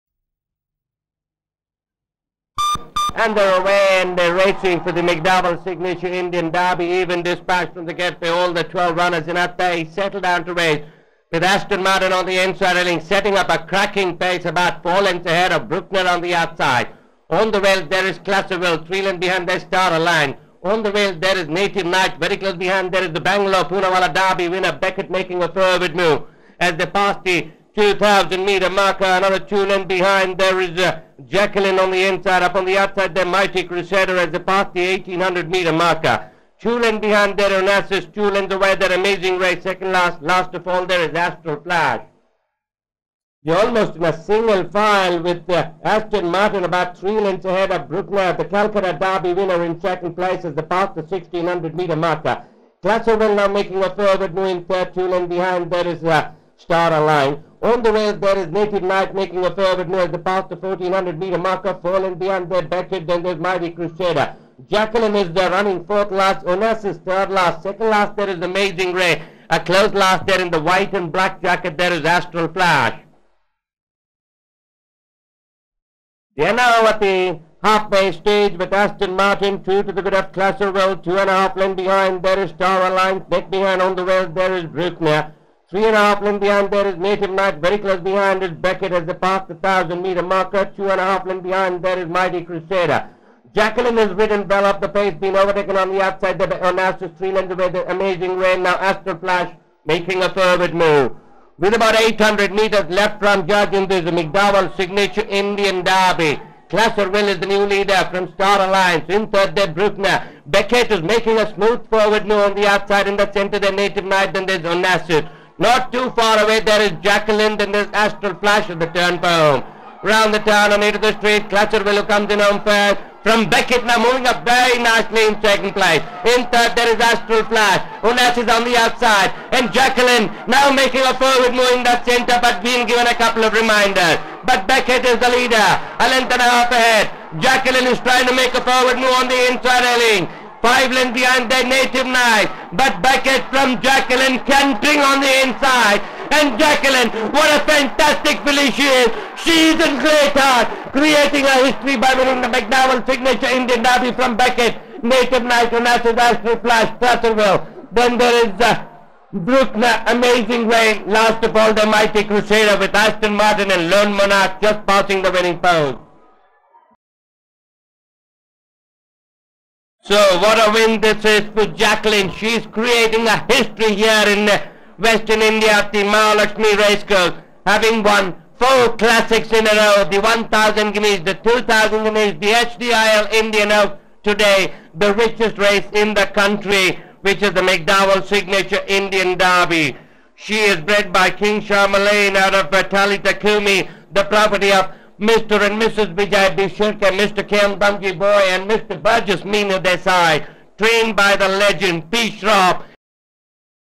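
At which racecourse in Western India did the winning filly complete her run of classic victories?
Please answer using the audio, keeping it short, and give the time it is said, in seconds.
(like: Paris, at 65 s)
Mahalakshmi Racecourse, at 176 s.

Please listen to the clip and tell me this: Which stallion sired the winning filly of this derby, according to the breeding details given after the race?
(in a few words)
King Charlemagne.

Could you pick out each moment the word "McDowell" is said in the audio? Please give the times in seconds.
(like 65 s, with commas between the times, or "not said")
5 s, 104 s, 152 s, 187 s.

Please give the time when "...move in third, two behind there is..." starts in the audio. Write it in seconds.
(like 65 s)
54 s.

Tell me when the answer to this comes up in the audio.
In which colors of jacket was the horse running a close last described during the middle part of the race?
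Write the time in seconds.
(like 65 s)
70 s.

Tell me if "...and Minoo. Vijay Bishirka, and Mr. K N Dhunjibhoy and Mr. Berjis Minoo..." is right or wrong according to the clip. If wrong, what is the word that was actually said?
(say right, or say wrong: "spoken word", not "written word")
wrong: "Mrs", not "Minoo".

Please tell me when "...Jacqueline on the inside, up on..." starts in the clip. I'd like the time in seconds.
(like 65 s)
31 s.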